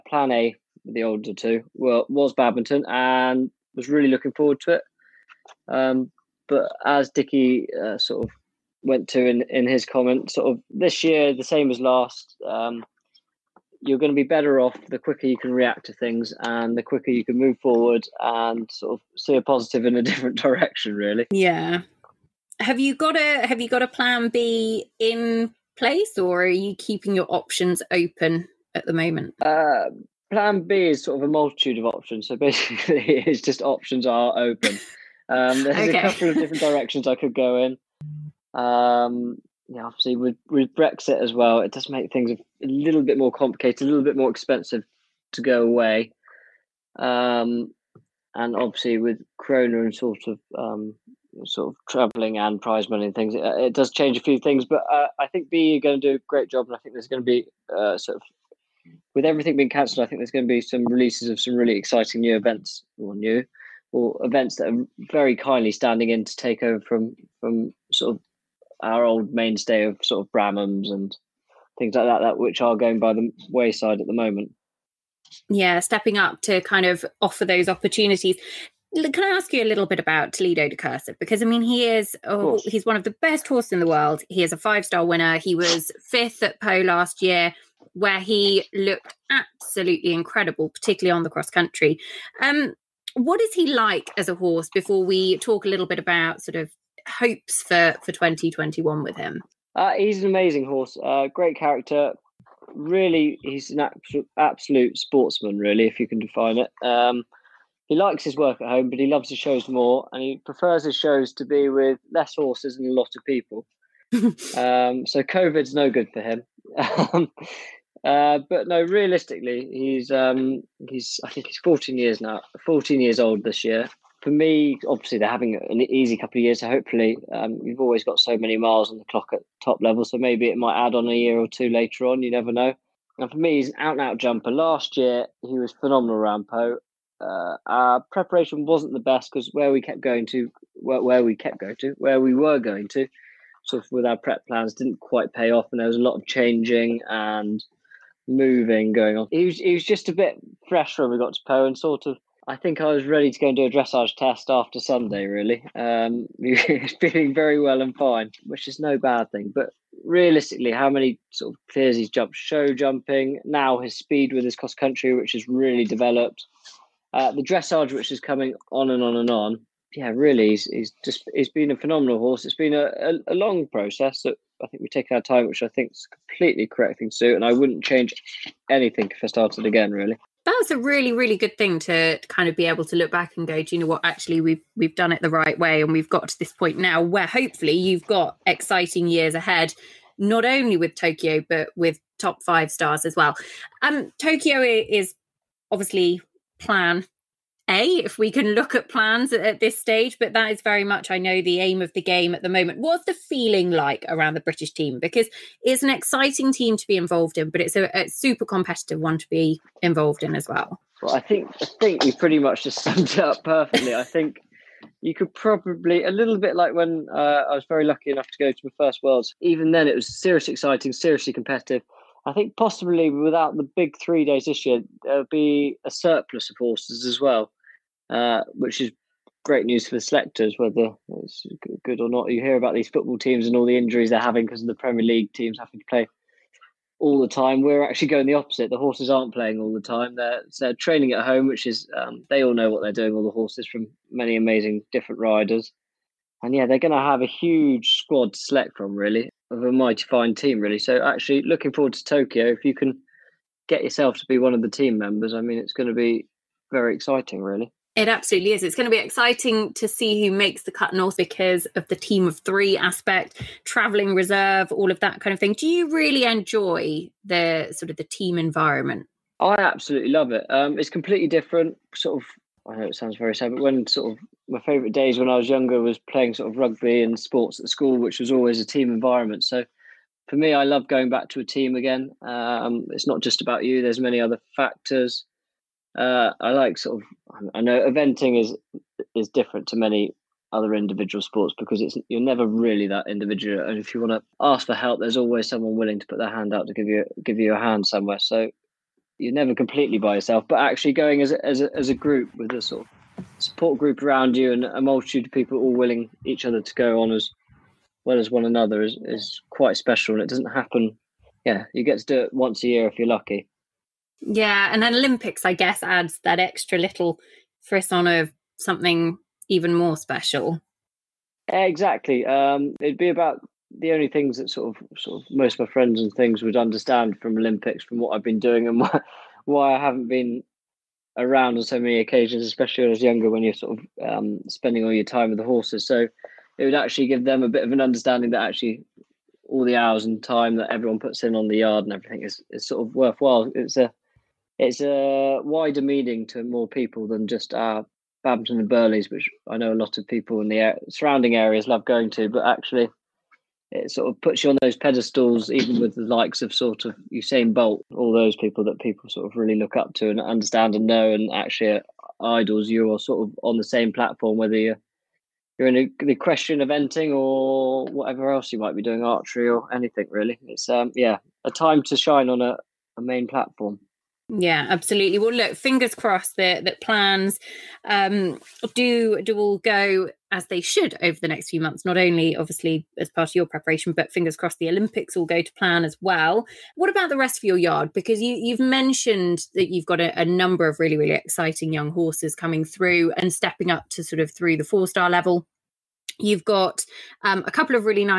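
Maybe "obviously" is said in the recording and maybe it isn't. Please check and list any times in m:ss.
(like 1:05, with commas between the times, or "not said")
0:39, 0:48, 2:04, 3:15, 6:22.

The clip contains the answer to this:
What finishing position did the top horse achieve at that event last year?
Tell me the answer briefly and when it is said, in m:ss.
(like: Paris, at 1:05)
5th, at 1:26.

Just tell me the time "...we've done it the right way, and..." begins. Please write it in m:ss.
3:04.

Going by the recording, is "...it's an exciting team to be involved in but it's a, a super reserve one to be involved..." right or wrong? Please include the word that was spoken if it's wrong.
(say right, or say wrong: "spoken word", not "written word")
wrong: "competitive", not "reserve".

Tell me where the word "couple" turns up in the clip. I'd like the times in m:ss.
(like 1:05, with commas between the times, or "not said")
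0:36, 2:06, 6:37.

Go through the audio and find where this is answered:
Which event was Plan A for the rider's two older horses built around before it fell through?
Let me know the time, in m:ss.
0:02.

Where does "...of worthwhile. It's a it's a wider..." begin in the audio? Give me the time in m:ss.
5:42.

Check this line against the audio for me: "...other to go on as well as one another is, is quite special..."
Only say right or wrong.
right.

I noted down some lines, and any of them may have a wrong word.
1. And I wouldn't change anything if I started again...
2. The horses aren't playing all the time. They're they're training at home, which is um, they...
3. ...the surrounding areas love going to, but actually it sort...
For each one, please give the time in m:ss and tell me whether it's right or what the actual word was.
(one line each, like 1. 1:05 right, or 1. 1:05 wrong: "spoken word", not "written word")
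1. 2:57 right
2. 3:58 right
3. 5:50 right.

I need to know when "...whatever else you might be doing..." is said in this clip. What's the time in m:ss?
6:07.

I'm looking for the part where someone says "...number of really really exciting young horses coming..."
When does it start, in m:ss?
6:30.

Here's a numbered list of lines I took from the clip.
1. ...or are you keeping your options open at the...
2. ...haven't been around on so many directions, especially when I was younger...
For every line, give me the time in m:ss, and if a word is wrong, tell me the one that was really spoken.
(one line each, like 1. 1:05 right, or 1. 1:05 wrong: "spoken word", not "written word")
1. 0:26 right
2. 5:29 wrong: "occasions", not "directions".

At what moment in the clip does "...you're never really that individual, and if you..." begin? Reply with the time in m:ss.
4:52.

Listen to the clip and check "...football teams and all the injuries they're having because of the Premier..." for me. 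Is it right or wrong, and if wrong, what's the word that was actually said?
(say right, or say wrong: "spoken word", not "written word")
right.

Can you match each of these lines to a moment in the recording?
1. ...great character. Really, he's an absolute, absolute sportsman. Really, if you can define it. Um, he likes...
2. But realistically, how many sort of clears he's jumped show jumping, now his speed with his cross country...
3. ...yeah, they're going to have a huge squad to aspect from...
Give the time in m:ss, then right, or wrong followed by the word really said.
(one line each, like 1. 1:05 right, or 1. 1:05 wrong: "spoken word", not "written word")
1. 1:41 right
2. 2:39 right
3. 4:06 wrong: "select", not "aspect".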